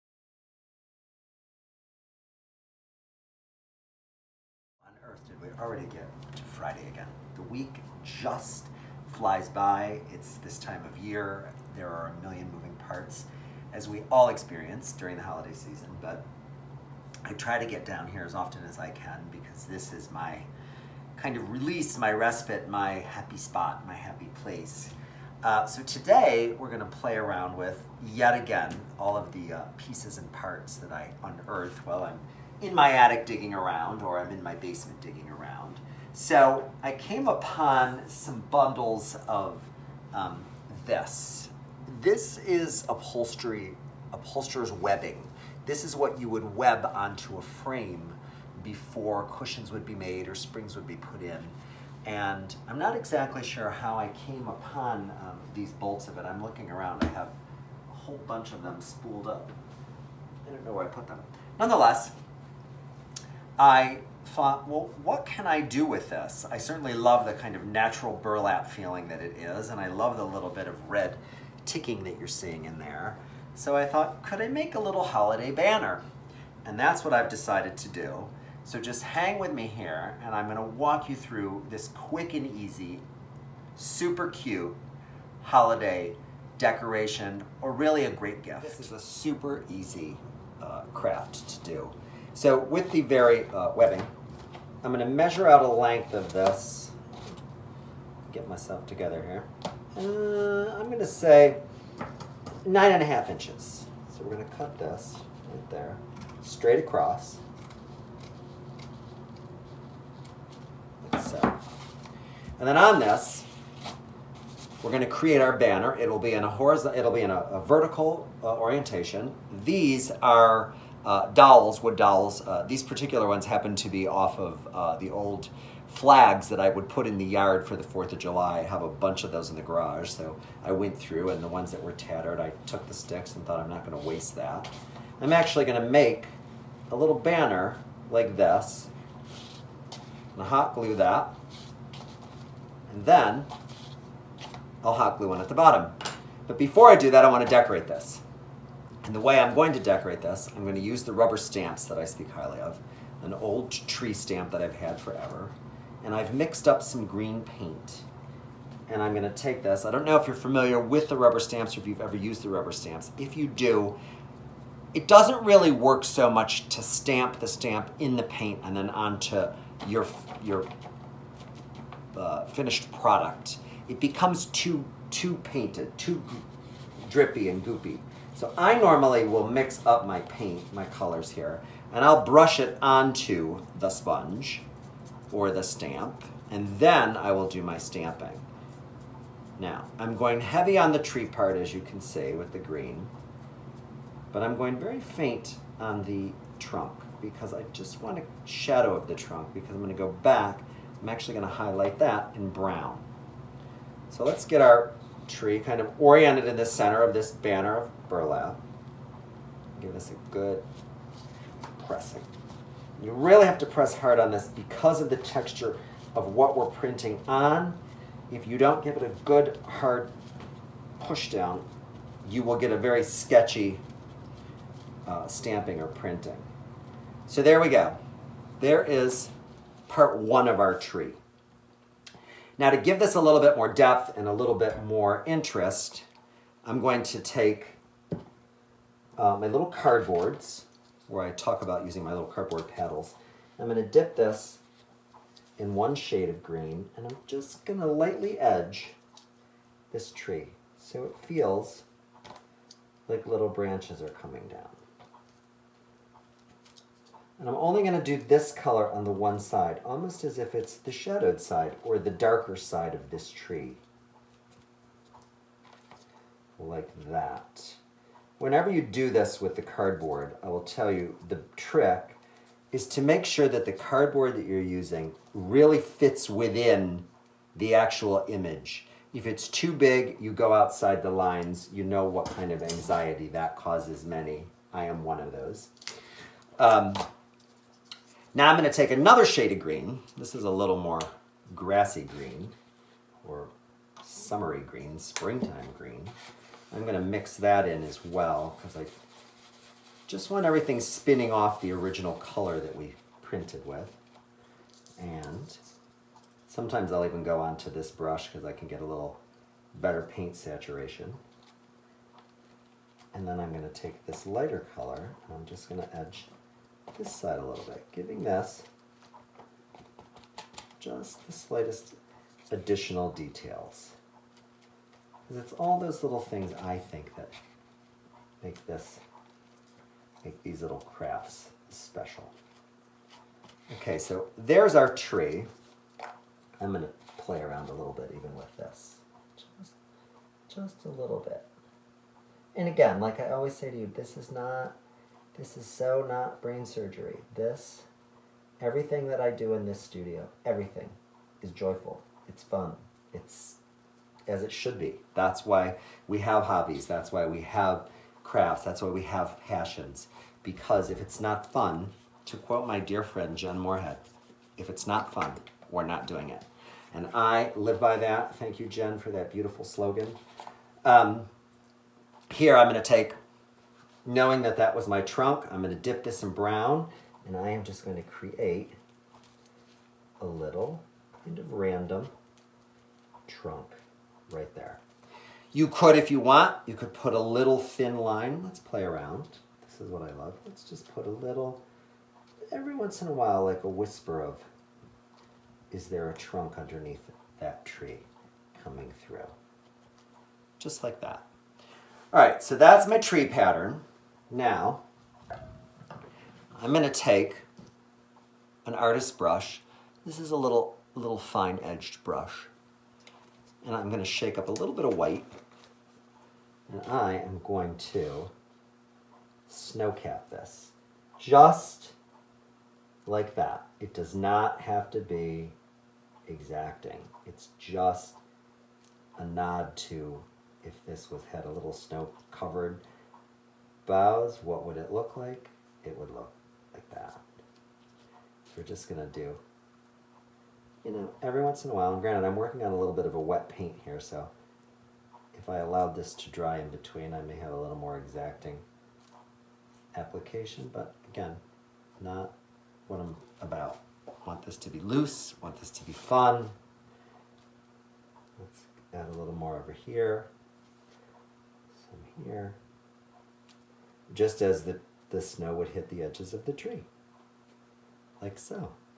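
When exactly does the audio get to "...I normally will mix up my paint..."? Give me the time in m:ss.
2:58.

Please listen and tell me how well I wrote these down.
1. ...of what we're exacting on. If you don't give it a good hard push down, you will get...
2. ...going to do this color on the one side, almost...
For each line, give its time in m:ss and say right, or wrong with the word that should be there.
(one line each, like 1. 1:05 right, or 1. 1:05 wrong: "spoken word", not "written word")
1. 3:36 wrong: "printing", not "exacting"
2. 4:17 right.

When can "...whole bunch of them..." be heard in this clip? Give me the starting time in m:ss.
0:57.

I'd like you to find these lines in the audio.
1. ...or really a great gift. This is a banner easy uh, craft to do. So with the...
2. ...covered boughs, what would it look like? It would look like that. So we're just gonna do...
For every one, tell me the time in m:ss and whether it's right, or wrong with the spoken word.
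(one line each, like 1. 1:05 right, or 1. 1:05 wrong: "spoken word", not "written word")
1. 1:27 wrong: "super", not "banner"
2. 7:12 right.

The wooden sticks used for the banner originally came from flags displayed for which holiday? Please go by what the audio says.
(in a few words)
4th of July.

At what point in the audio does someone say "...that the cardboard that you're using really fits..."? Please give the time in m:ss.
4:33.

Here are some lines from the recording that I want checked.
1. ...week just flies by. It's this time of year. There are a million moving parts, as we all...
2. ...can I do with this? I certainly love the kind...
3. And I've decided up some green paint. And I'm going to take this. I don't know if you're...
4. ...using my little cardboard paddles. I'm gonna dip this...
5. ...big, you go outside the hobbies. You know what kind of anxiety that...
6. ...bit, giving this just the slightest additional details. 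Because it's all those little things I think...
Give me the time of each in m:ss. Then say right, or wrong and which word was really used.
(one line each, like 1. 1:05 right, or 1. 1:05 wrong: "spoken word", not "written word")
1. 0:07 right
2. 1:05 right
3. 2:36 wrong: "mixed", not "decided"
4. 4:01 right
5. 4:39 wrong: "lines", not "hobbies"
6. 5:17 right.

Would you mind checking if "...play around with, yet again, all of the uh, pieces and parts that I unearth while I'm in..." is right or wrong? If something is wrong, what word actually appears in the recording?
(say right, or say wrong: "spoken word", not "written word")
right.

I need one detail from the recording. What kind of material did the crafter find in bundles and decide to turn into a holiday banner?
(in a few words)
upholsterer's webbing.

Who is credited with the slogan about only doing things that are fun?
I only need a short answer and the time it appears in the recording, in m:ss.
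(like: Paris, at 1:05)
Jen Moorhead, at 6:03.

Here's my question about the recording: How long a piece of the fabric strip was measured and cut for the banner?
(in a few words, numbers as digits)
9.5 inches.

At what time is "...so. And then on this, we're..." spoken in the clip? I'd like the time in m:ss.
1:51.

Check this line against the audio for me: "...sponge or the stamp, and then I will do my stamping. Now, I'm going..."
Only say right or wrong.
right.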